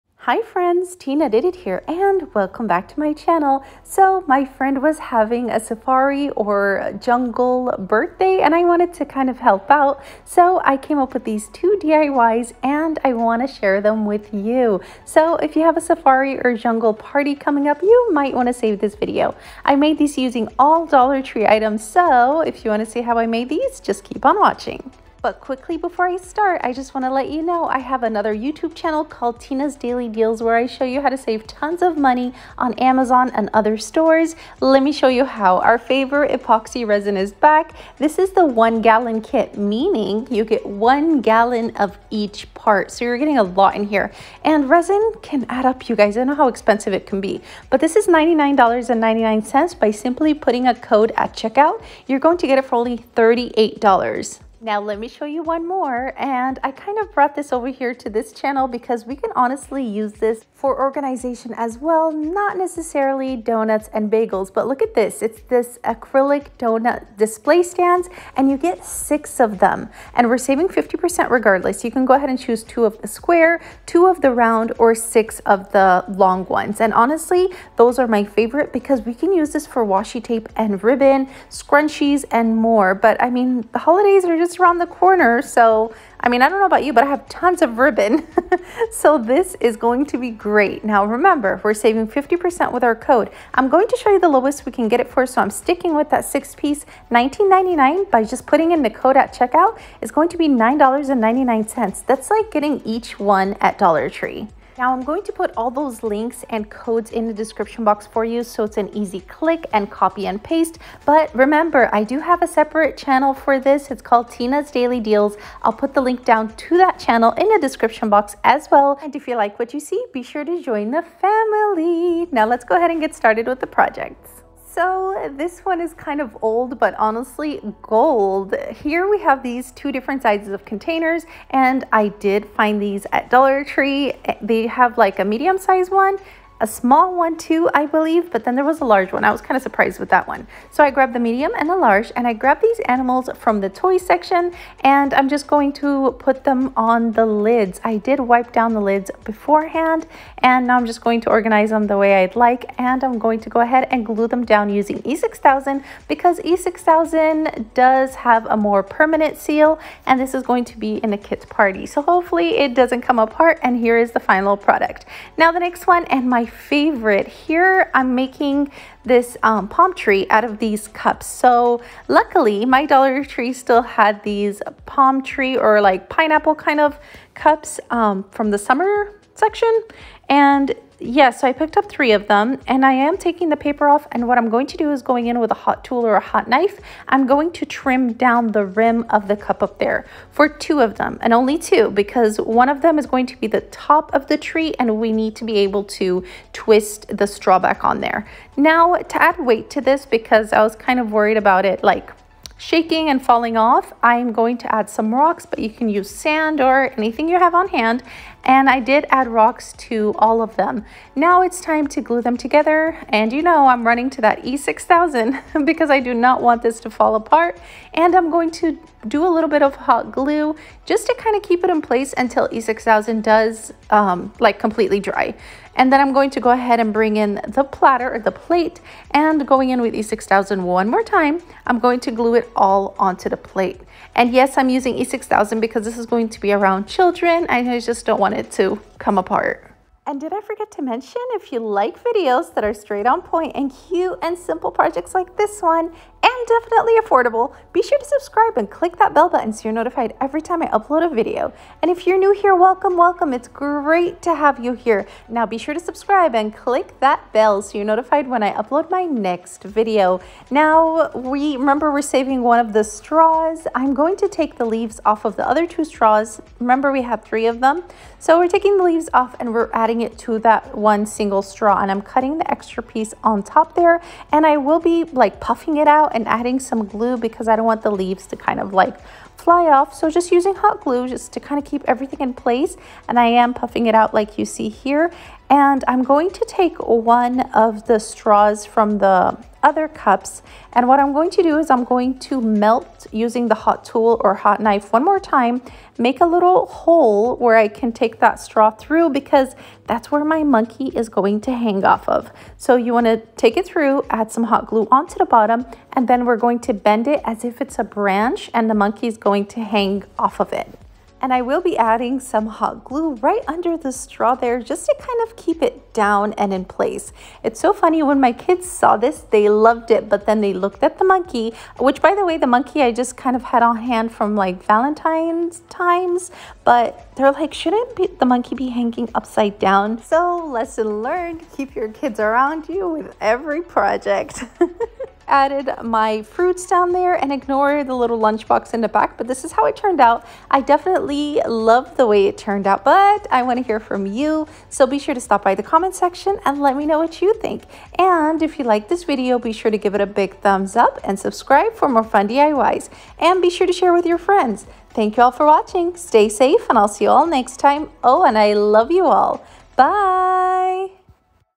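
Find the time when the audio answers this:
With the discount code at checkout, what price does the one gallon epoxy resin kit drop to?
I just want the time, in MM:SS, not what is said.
00:53.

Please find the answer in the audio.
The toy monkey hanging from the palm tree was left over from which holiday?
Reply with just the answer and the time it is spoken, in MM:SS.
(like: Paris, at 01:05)
Valentine's, at 05:24.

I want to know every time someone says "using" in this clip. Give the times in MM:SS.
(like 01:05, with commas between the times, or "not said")
00:20, 02:34, 03:54, 04:40, 04:53.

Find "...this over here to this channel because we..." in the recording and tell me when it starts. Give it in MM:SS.
00:57.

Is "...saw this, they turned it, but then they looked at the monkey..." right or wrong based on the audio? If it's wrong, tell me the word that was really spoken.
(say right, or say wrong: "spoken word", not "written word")
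wrong: "loved", not "turned".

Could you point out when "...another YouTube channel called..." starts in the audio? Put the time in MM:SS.
00:28.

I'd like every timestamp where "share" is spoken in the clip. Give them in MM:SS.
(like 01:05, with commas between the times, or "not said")
00:13, 05:53.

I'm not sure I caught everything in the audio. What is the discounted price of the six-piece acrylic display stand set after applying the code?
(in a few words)
$9.99.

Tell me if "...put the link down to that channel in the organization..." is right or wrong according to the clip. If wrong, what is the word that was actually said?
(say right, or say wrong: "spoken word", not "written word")
wrong: "description", not "organization".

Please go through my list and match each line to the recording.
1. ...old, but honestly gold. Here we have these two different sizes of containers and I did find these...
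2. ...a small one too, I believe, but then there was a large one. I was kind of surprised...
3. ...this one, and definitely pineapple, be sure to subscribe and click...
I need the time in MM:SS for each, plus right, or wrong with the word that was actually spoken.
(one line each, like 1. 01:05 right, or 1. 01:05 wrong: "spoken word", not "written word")
1. 02:06 right
2. 02:16 right
3. 04:05 wrong: "affordable", not "pineapple".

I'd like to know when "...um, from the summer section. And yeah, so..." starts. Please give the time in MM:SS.
02:57.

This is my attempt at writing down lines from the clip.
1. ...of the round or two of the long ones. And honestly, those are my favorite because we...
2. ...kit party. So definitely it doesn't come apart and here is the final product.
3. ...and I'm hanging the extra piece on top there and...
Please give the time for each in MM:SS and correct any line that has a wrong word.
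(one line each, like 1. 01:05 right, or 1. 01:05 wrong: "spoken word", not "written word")
1. 01:14 wrong: "six", not "two"
2. 02:41 wrong: "hopefully", not "definitely"
3. 04:31 wrong: "cutting", not "hanging".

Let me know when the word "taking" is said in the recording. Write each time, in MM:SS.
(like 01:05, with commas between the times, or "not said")
03:03, 04:28.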